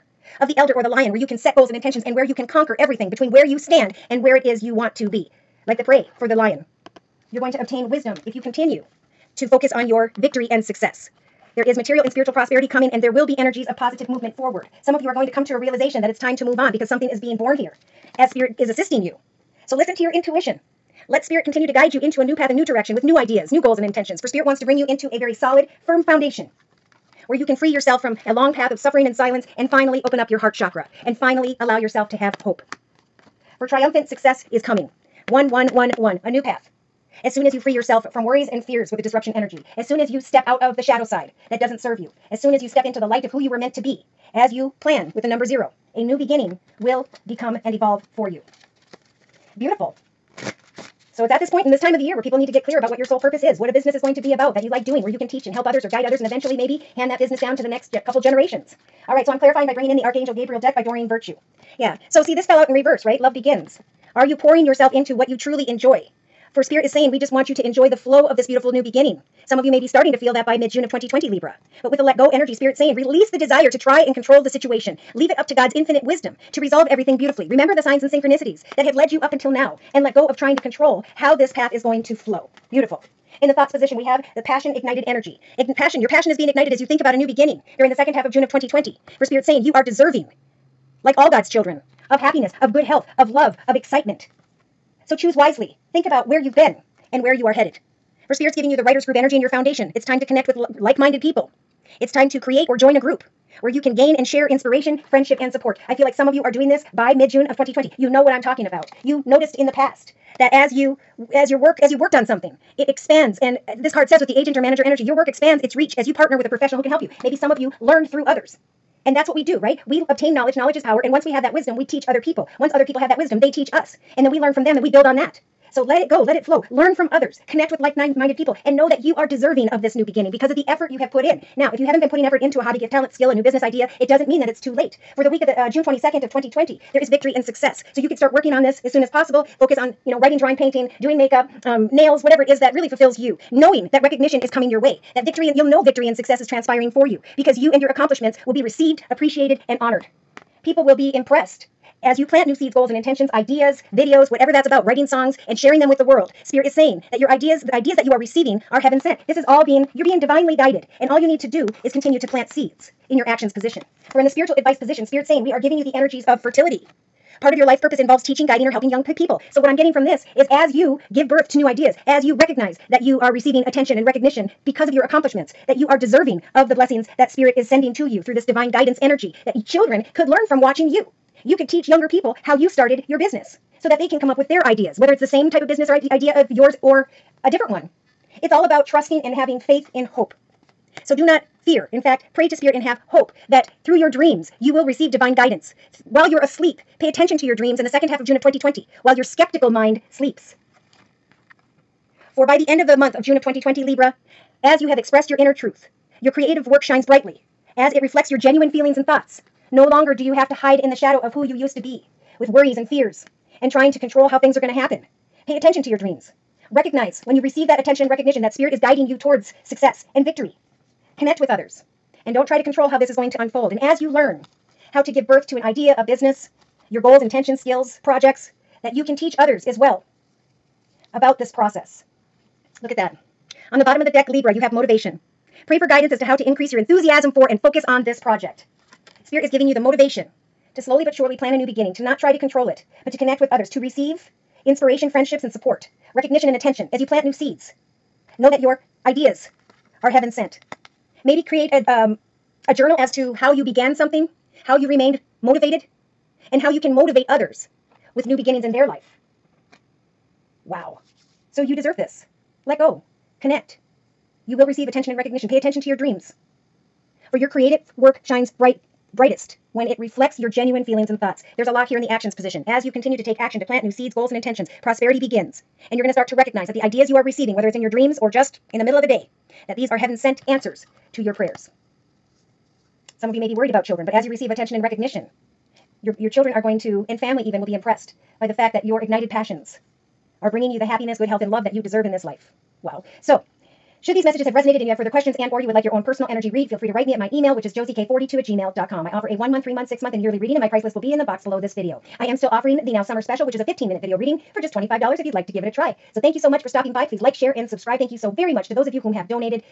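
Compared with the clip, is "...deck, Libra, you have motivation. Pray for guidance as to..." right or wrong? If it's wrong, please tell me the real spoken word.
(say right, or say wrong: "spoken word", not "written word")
right.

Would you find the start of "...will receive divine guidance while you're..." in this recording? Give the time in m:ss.
3:14.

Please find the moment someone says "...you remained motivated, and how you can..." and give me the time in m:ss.
4:14.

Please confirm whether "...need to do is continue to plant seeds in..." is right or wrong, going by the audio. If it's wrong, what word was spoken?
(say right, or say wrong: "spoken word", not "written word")
right.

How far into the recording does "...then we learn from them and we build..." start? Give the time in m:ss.
2:04.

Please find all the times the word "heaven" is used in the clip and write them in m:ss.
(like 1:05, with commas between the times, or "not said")
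2:38, 4:10, 4:39.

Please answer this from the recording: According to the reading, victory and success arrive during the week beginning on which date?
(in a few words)
June 22nd, 2020.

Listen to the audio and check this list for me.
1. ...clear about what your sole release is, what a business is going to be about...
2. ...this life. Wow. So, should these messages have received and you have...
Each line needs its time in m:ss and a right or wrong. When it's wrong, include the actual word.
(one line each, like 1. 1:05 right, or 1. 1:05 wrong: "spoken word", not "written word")
1. 0:52 wrong: "purpose", not "release"
2. 4:52 wrong: "resonated", not "received".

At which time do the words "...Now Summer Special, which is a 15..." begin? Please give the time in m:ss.
5:02.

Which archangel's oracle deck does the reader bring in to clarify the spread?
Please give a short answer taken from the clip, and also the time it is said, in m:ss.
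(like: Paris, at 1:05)
Gabriel, at 1:00.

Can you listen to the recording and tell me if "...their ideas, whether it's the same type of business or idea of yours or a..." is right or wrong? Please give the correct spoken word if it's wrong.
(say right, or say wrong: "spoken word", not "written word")
right.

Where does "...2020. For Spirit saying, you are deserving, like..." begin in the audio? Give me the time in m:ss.
1:28.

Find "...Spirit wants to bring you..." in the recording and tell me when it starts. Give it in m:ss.
0:24.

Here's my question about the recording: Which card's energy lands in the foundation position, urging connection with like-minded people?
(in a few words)
Writers group.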